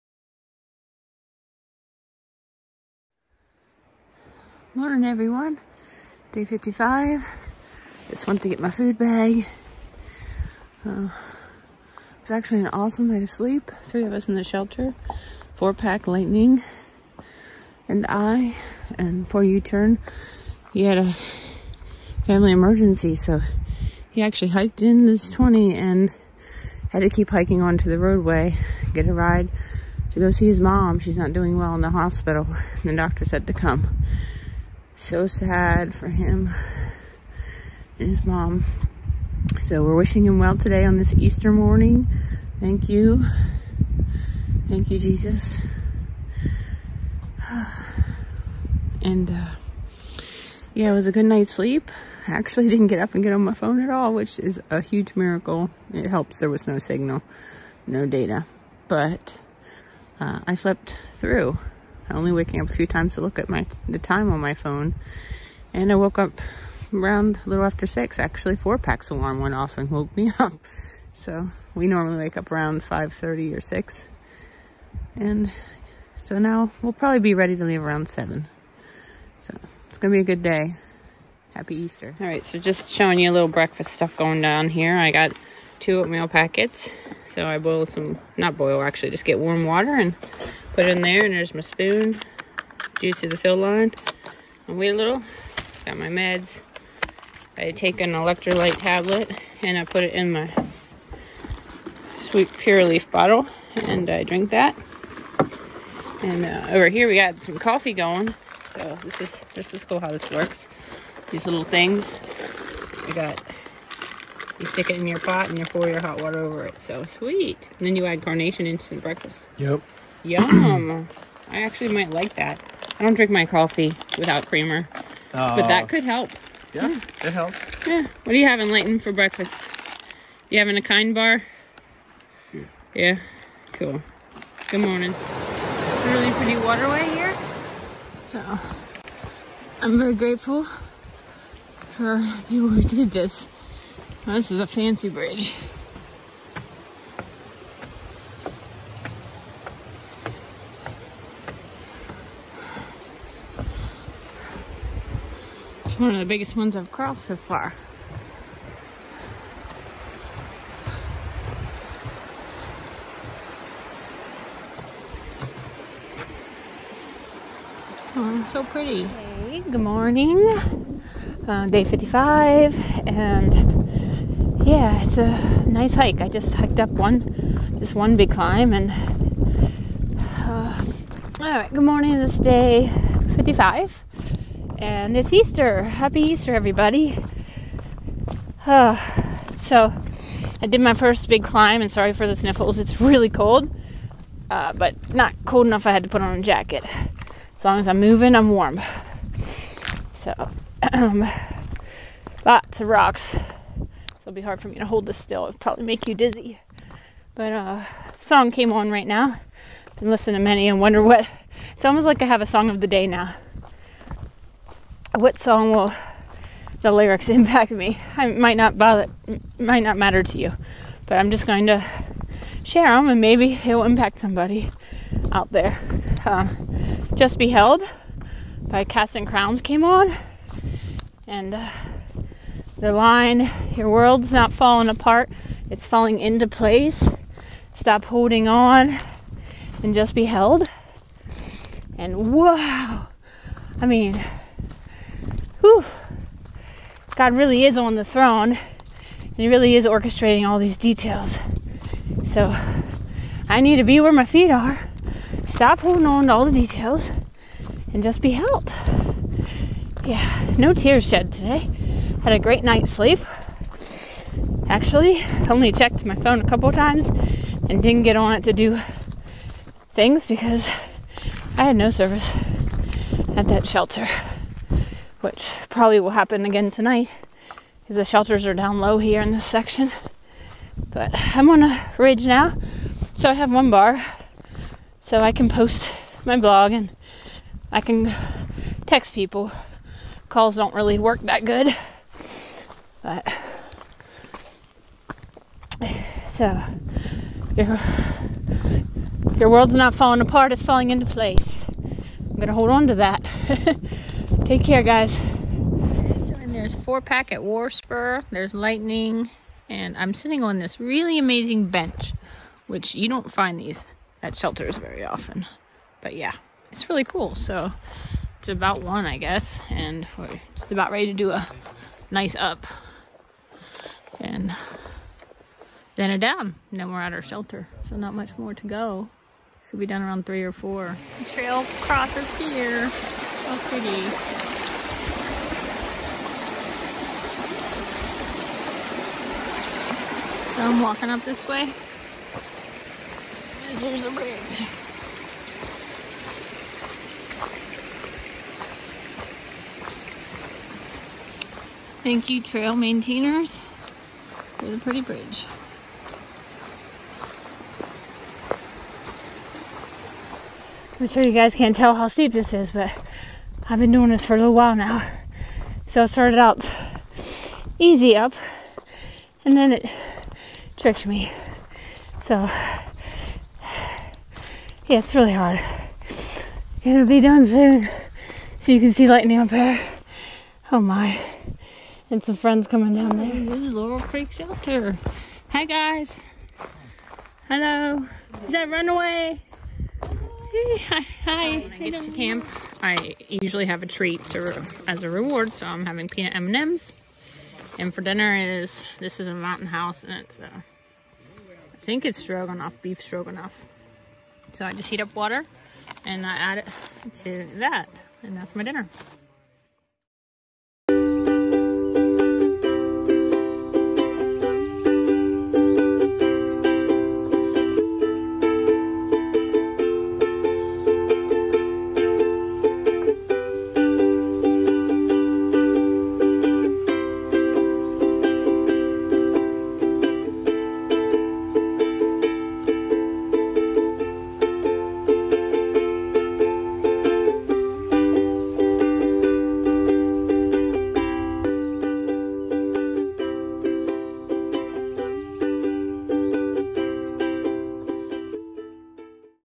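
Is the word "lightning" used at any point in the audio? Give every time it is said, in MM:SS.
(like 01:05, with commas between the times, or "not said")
00:16, 05:08, 06:19.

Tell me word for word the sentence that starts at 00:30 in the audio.
She's not doing well in the hospital.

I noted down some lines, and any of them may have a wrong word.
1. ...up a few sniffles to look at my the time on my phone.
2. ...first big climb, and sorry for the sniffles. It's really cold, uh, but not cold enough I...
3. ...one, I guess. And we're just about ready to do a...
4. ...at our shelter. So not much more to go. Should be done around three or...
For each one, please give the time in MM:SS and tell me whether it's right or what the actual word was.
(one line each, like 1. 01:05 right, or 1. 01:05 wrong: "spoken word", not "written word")
1. 01:02 wrong: "times", not "sniffles"
2. 03:10 right
3. 05:18 right
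4. 05:26 right.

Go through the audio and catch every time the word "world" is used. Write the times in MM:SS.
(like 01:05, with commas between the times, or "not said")
03:53, 04:59.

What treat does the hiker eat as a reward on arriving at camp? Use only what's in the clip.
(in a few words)
Peanut M&Ms.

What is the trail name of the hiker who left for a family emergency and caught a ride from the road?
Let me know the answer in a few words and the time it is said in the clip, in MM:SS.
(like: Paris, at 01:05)
U-turn, at 00:19.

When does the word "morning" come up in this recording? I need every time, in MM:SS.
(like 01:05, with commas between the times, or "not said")
00:04, 00:41, 02:14, 02:49, 03:01.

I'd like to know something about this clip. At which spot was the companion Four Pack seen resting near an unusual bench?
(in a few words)
War Spur.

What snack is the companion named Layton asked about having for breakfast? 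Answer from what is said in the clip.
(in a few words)
Kind bar.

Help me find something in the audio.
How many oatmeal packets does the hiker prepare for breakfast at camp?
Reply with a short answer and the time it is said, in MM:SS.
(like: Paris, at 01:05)
2, at 01:25.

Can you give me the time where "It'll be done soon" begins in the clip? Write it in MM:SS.
06:16.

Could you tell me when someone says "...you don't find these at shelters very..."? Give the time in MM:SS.
05:12.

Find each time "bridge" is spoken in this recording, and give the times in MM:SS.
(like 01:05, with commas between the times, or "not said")
02:25, 05:44, 05:55.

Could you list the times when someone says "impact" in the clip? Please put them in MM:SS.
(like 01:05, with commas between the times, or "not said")
03:37, 03:43.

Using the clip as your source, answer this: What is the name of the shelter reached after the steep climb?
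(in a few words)
Laurel Creek Shelter.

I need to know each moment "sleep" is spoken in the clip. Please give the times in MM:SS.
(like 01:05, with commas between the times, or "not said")
00:13, 00:51, 04:22.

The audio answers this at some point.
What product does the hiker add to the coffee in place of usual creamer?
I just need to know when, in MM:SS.
01:58.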